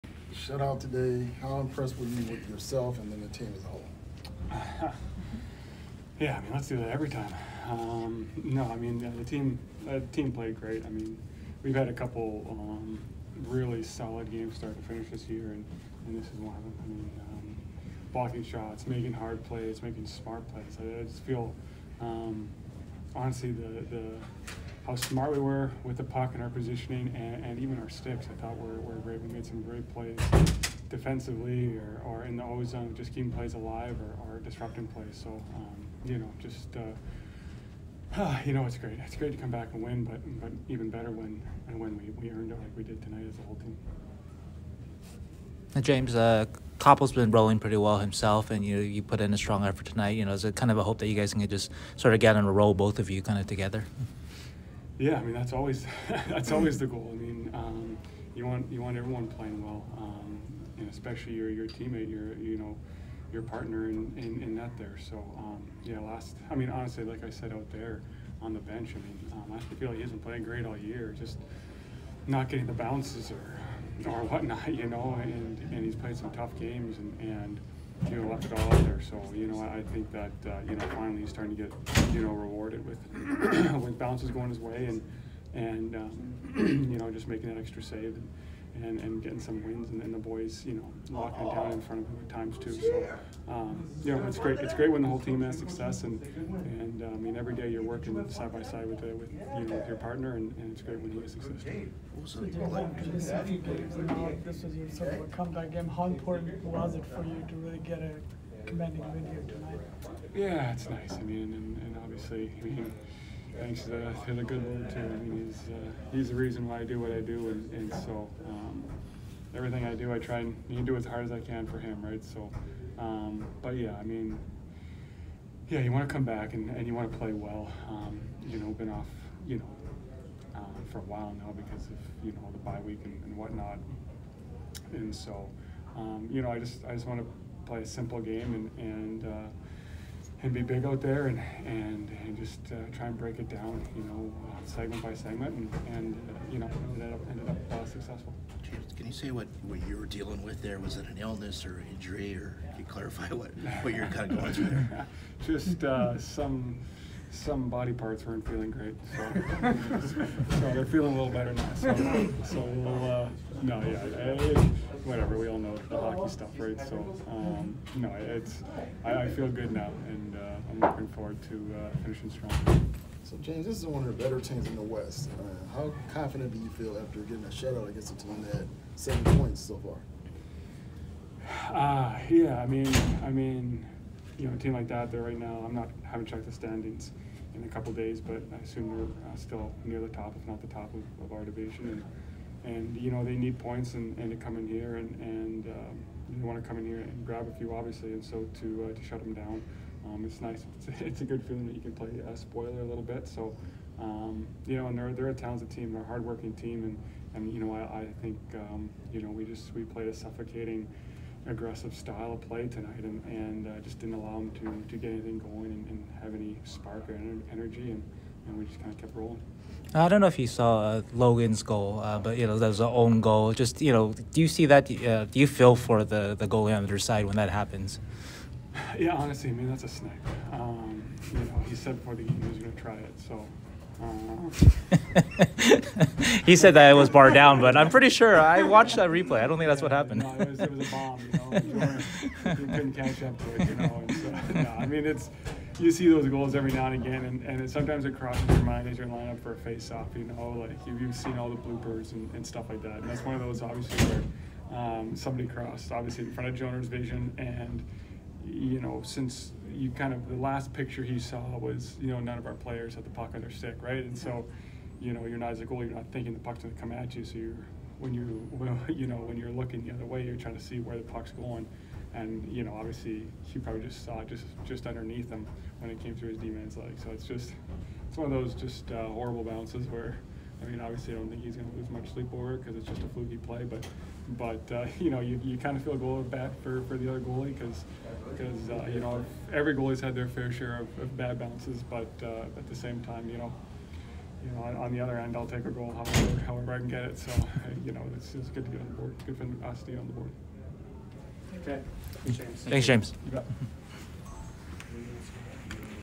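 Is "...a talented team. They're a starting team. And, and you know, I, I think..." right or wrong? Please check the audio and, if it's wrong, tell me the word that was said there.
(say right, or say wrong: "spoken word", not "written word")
wrong: "hardworking", not "starting".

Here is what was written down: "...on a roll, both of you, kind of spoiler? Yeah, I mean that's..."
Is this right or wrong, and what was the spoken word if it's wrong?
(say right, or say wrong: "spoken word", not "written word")
wrong: "together", not "spoiler".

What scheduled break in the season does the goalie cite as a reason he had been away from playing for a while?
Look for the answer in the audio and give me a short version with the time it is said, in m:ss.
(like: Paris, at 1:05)
bye week, at 2:12.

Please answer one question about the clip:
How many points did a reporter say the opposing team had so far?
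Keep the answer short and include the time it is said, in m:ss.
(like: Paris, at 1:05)
7, at 2:58.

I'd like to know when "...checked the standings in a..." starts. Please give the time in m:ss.
3:06.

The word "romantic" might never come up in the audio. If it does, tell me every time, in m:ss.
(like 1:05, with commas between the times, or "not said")
not said.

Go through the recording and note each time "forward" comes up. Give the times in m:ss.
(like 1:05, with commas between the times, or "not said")
2:51.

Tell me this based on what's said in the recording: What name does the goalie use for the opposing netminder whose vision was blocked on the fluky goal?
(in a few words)
Joner.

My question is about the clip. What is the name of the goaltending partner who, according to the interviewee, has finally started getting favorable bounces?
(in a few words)
Kaapo.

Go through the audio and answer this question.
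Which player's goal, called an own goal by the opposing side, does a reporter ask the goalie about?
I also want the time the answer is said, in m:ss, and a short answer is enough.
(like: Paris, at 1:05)
Logan, at 3:41.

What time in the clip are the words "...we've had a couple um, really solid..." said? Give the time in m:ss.
0:11.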